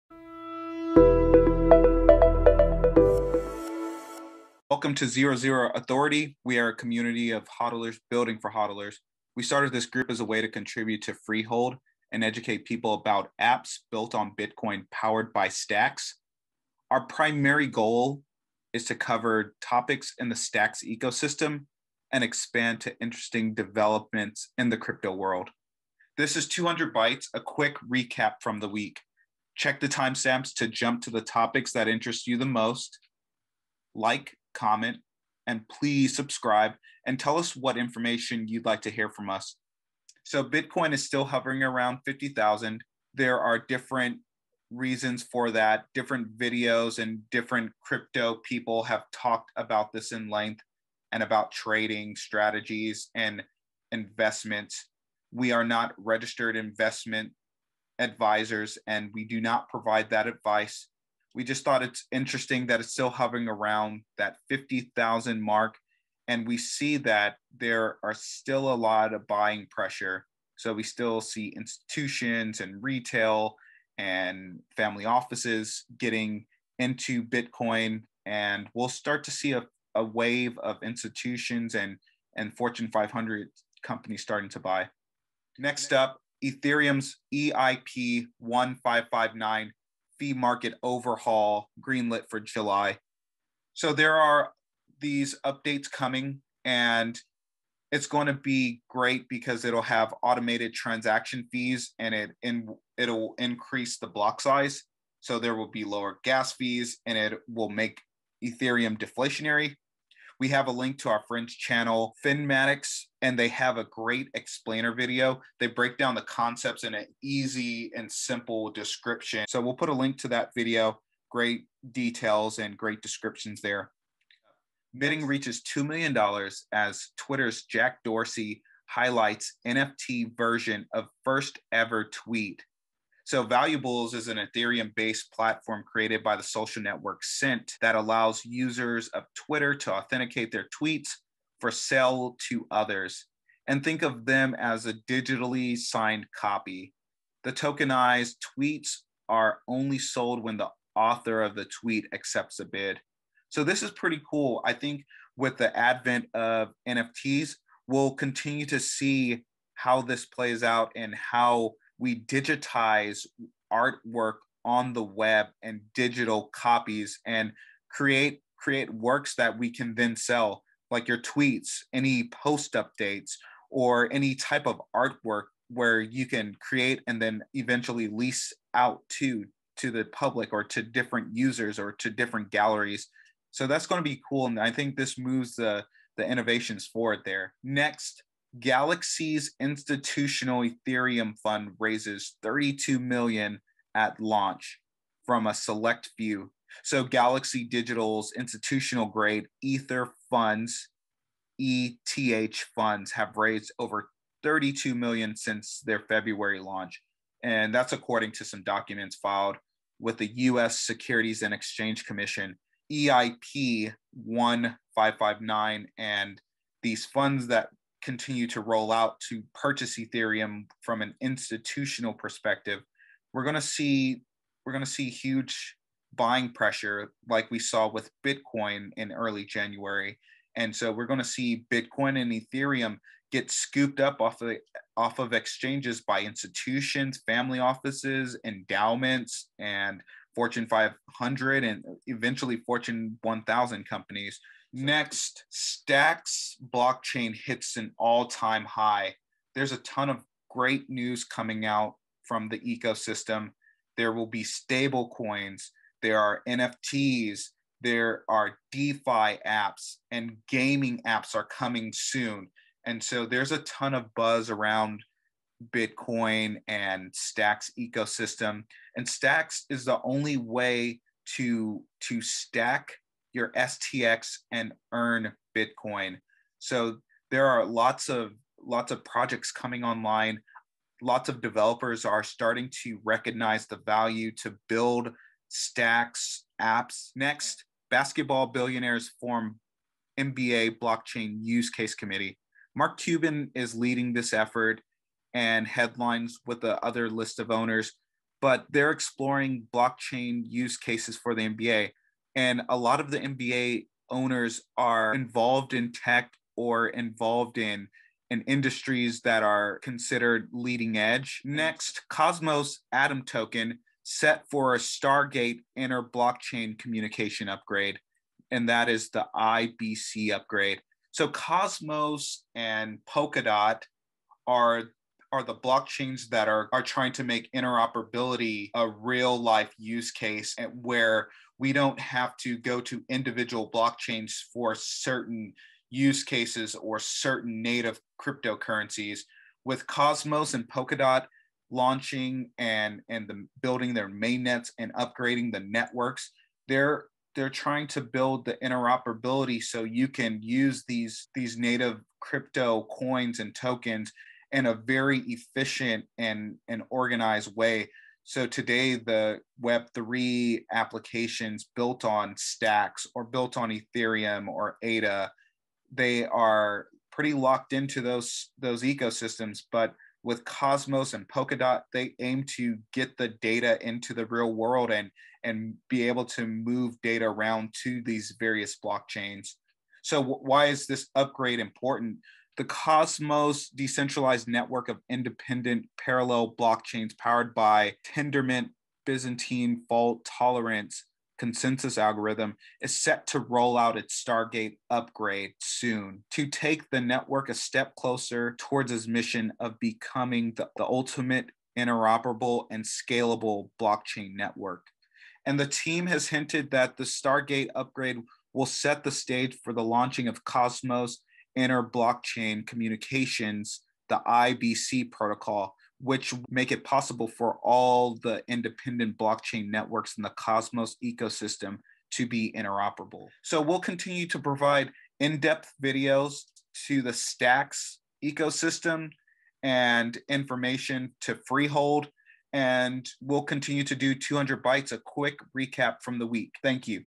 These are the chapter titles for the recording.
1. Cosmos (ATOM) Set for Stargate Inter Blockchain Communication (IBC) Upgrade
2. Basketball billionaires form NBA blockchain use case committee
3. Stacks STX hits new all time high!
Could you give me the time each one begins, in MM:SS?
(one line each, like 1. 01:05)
1. 05:10
2. 04:46
3. 04:04.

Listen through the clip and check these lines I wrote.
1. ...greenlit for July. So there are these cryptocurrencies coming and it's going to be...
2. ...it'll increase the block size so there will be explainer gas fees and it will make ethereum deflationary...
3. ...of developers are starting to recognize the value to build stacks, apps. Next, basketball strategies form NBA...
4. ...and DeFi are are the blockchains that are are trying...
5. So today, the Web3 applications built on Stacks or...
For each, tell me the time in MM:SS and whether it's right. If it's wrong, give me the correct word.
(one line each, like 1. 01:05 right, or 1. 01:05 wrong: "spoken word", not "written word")
1. 01:31 wrong: "updates", not "cryptocurrencies"
2. 01:42 wrong: "lower", not "explainer"
3. 04:41 wrong: "billionaires", not "strategies"
4. 05:22 wrong: "Polkadot", not "DeFi"
5. 05:58 right.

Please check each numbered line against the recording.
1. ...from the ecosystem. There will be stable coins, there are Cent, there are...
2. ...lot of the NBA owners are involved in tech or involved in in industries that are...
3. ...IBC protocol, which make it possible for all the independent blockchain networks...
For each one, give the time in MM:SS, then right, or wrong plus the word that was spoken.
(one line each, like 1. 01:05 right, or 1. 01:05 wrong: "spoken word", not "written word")
1. 04:12 wrong: "NFTs", not "Cent"
2. 05:02 right
3. 06:54 right.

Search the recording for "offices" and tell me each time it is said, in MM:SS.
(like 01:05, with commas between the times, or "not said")
01:15, 03:57.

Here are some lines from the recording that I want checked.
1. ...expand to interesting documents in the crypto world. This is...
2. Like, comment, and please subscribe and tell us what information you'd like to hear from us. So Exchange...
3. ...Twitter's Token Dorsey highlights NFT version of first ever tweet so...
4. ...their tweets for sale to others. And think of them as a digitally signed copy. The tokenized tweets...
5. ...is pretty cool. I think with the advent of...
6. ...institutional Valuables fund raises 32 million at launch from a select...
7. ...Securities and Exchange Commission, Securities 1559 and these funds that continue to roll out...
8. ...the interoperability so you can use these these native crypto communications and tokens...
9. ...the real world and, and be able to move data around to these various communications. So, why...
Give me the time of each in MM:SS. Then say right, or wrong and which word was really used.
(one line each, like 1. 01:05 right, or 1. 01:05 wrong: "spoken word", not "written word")
1. 00:22 wrong: "developments", not "documents"
2. 00:33 wrong: "Bitcoin", not "Exchange"
3. 02:07 wrong: "Jack", not "Token"
4. 02:20 right
5. 02:33 right
6. 03:09 wrong: "Ethereum", not "Valuables"
7. 03:30 wrong: "EIP", not "Securities"
8. 05:48 wrong: "coins", not "communications"
9. 06:14 wrong: "blockchains", not "communications".